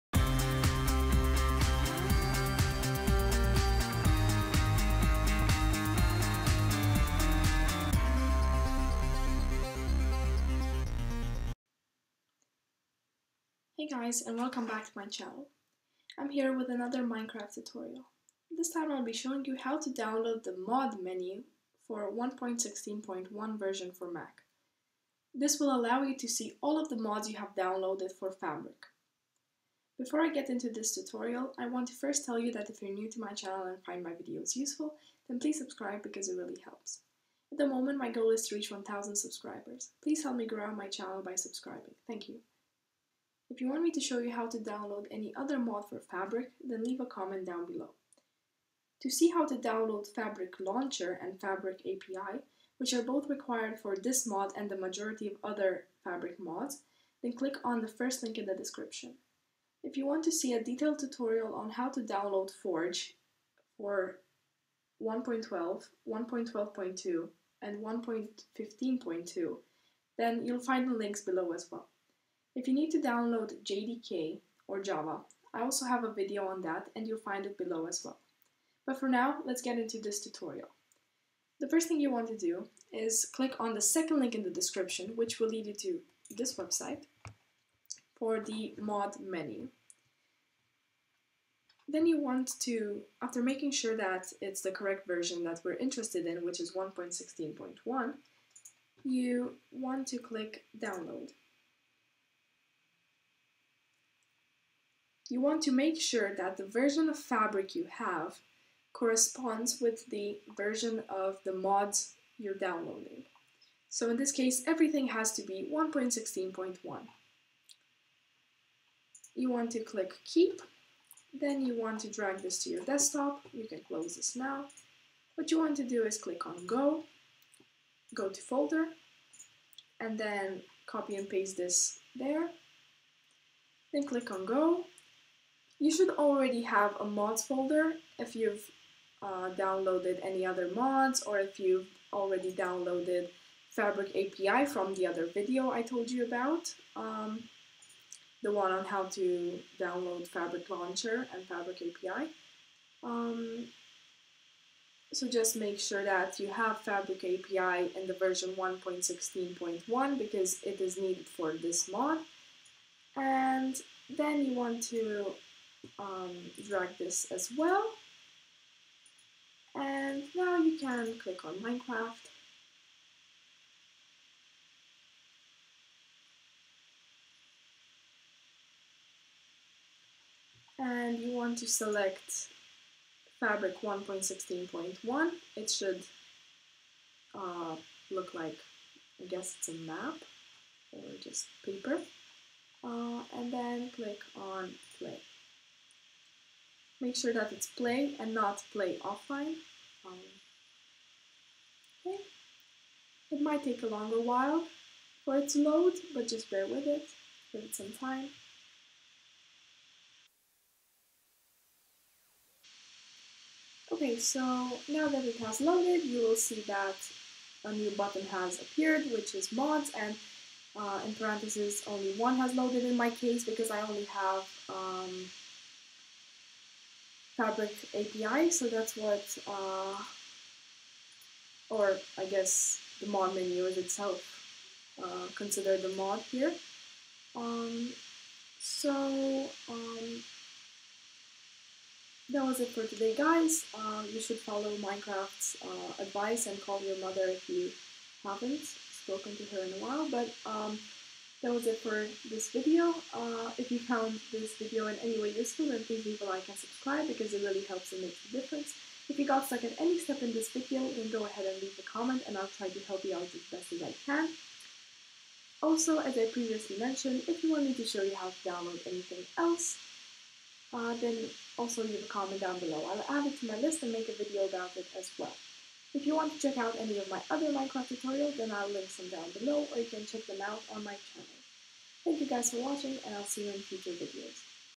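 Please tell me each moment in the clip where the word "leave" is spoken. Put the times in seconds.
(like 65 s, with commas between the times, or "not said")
46 s, 256 s, 261 s, 271 s.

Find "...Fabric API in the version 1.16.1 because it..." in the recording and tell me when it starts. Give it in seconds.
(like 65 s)
156 s.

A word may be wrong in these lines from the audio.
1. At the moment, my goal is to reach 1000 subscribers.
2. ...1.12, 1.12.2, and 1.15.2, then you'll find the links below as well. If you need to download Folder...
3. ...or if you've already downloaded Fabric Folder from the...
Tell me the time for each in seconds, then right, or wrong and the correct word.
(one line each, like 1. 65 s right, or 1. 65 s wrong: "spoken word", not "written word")
1. 37 s right
2. 65 s wrong: "JDK", not "Folder"
3. 141 s wrong: "API", not "Folder".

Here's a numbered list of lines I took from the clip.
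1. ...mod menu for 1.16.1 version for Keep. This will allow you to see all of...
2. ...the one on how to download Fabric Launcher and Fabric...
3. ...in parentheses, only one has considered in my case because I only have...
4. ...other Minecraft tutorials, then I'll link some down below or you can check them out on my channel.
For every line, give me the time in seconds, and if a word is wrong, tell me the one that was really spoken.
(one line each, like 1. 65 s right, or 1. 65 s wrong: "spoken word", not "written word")
1. 20 s wrong: "Mac", not "Keep"
2. 148 s right
3. 221 s wrong: "loaded", not "considered"
4. 277 s right.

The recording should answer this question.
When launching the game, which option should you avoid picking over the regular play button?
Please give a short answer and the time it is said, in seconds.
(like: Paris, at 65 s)
Play offline, at 198 s.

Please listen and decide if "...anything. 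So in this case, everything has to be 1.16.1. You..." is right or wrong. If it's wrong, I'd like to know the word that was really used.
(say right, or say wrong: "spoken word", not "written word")
wrong: "downloading", not "anything".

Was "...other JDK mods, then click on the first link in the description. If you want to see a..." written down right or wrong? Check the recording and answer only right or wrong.
wrong.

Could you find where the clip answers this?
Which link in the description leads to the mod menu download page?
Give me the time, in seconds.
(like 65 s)
83 s.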